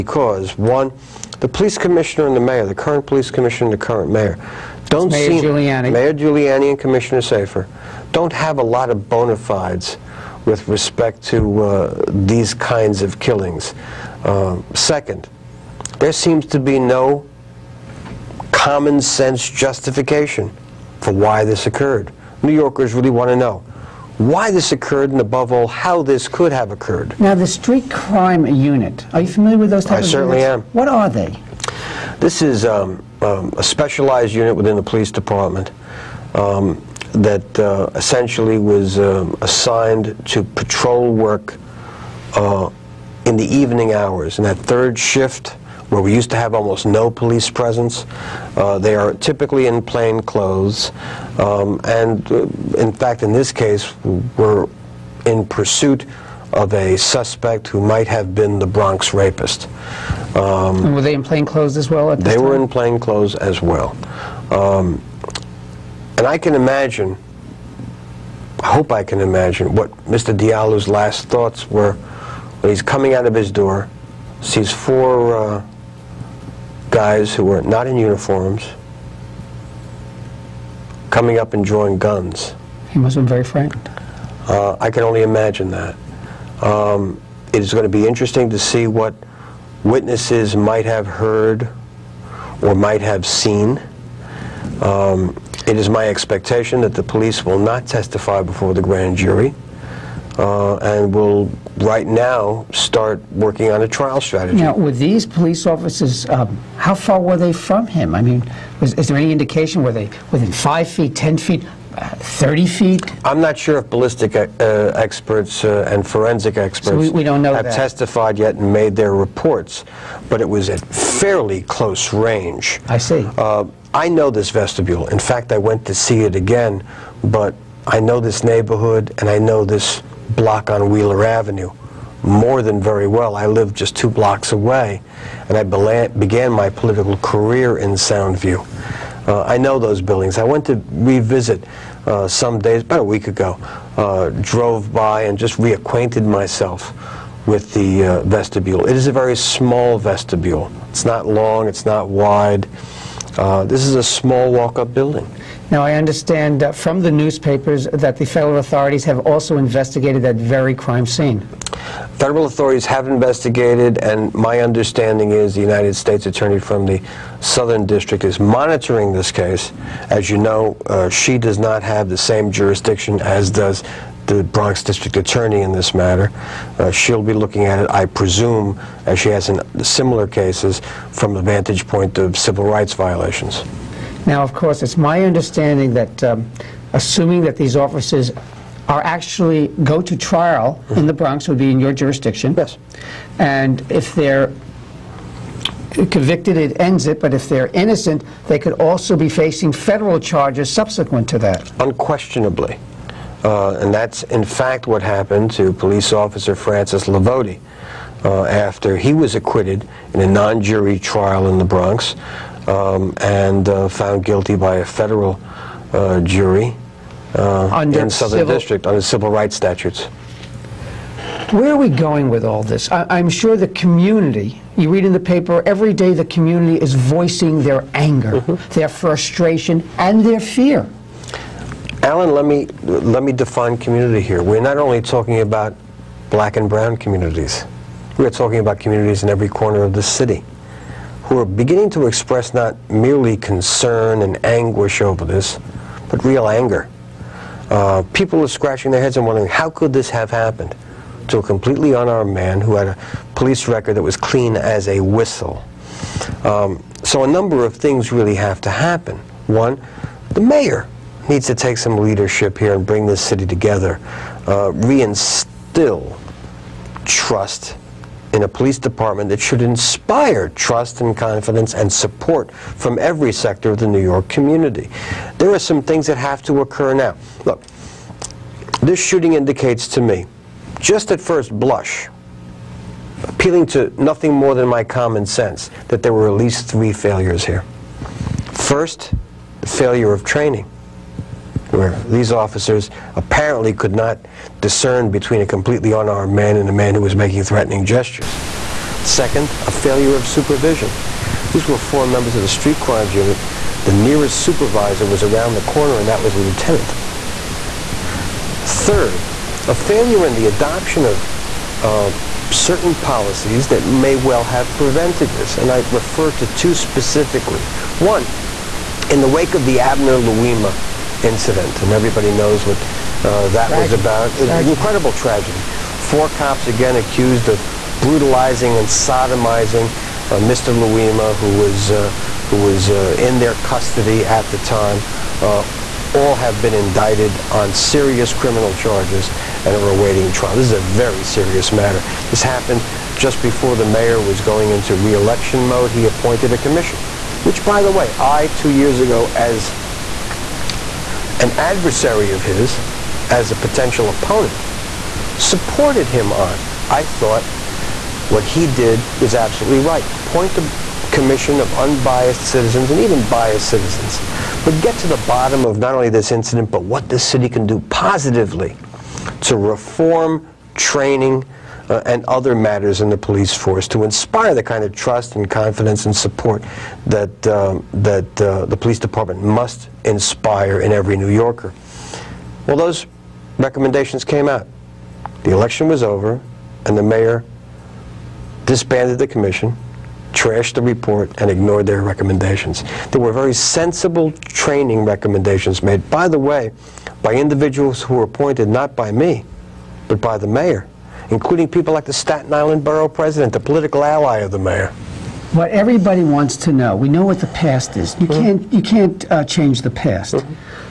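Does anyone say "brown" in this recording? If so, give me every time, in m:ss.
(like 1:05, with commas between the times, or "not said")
3:56.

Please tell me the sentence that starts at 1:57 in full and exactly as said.
testified yet and made their reports, but it was at fairly close range.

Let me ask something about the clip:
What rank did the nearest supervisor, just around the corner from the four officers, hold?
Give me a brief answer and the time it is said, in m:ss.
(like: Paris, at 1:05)
Lieutenant, at 5:06.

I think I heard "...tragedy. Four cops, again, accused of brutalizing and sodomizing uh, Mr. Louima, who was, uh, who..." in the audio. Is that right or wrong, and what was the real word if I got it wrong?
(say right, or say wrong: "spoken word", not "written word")
right.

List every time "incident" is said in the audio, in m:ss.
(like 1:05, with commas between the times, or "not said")
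5:21, 6:06.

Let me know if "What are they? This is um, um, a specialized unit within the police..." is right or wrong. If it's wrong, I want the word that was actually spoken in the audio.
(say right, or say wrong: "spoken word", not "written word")
right.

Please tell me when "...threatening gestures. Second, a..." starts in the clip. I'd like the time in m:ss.
4:57.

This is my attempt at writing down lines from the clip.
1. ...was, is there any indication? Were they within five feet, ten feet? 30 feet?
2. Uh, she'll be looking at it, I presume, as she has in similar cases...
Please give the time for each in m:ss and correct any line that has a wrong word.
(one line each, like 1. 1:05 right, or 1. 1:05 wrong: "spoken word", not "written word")
1. 1:48 right
2. 2:56 right.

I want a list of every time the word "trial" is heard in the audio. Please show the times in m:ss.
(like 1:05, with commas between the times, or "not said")
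1:43, 3:10, 3:30, 5:40.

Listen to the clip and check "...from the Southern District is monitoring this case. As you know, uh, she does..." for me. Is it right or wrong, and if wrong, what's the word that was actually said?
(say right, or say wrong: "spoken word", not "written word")
right.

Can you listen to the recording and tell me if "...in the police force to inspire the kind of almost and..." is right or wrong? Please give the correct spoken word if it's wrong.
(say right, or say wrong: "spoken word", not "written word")
wrong: "trust", not "almost".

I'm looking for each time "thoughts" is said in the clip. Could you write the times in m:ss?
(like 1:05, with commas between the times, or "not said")
1:11, 5:57.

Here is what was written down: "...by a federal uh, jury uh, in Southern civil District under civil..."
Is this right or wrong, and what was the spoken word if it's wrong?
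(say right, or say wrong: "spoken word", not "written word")
right.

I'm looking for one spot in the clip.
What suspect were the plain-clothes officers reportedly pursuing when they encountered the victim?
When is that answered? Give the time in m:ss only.
0:58.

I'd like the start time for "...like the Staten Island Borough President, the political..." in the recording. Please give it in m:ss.
6:41.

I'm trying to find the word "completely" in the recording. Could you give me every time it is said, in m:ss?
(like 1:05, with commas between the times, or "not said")
4:11, 4:55.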